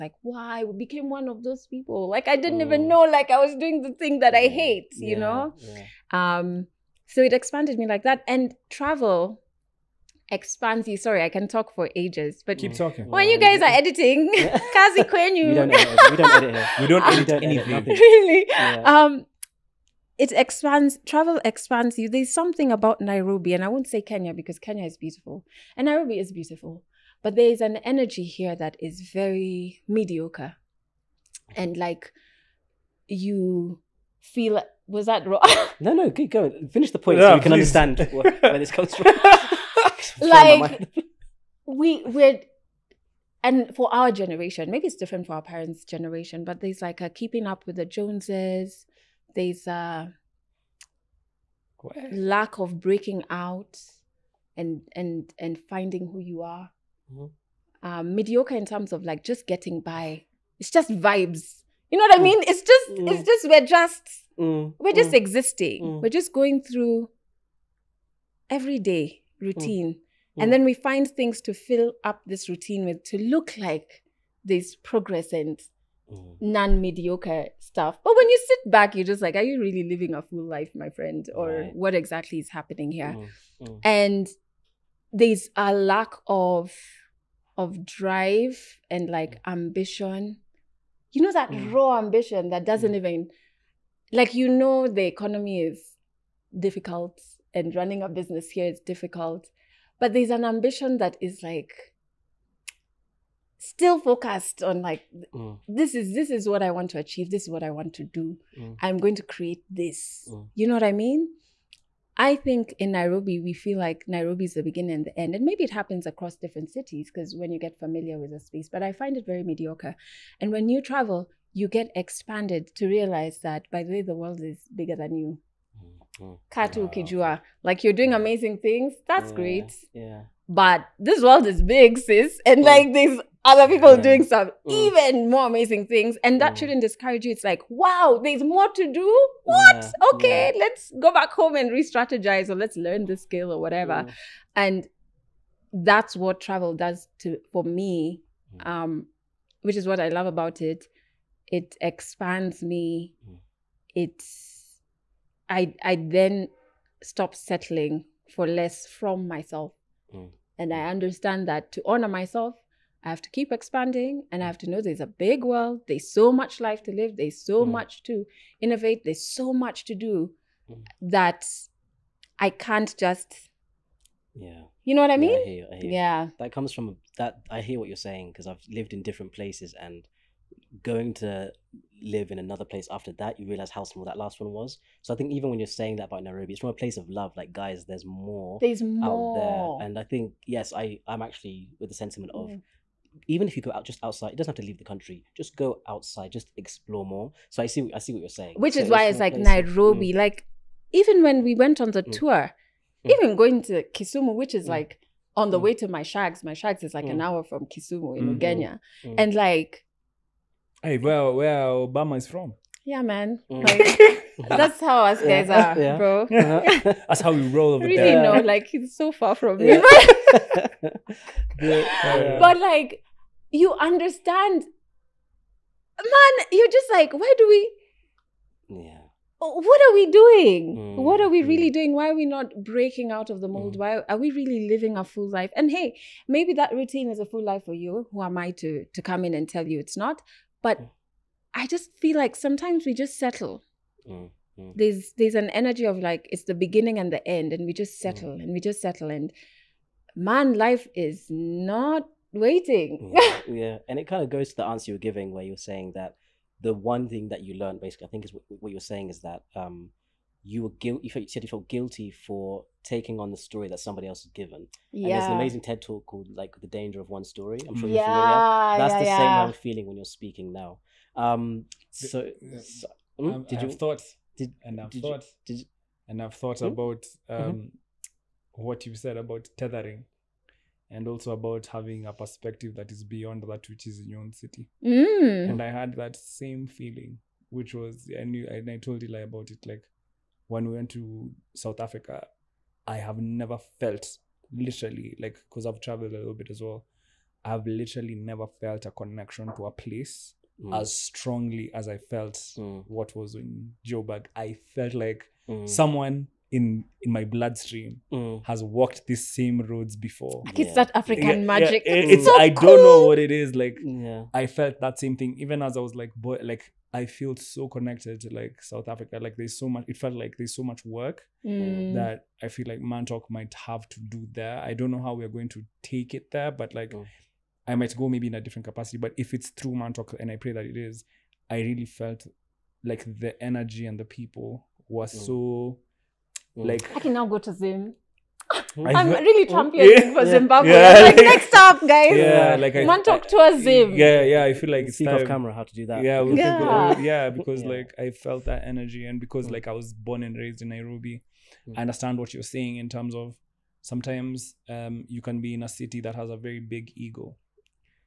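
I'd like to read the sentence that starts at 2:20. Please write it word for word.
okay let's go back home and re-strategize or let's learn the skill or whatever mm.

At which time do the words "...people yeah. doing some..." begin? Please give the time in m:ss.
2:13.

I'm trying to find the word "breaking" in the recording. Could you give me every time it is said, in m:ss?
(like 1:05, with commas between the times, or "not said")
0:52, 3:52.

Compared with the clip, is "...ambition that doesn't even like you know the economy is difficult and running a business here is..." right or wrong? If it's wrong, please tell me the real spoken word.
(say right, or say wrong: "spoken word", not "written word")
right.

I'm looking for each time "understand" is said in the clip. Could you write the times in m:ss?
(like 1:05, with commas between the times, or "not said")
0:37, 2:40, 3:43, 5:51.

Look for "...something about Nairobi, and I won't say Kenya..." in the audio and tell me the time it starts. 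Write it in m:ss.
0:22.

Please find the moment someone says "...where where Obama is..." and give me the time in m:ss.
3:30.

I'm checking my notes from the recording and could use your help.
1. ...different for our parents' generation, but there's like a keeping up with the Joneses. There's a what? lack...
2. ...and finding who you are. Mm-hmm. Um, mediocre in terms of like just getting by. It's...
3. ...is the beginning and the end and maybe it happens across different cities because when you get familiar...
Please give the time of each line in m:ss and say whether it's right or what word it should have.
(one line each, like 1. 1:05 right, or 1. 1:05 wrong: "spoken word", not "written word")
1. 0:44 right
2. 0:55 right
3. 1:54 right.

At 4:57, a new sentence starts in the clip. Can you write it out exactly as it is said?
I've literally never felt a connection to a place mm.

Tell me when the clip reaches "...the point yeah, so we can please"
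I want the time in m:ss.
0:36.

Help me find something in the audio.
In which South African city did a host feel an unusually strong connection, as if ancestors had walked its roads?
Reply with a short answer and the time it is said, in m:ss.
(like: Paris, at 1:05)
Joburg, at 5:03.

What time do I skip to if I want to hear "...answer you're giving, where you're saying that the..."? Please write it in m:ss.
4:14.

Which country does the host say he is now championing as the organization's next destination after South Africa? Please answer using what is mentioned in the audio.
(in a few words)
Zimbabwe.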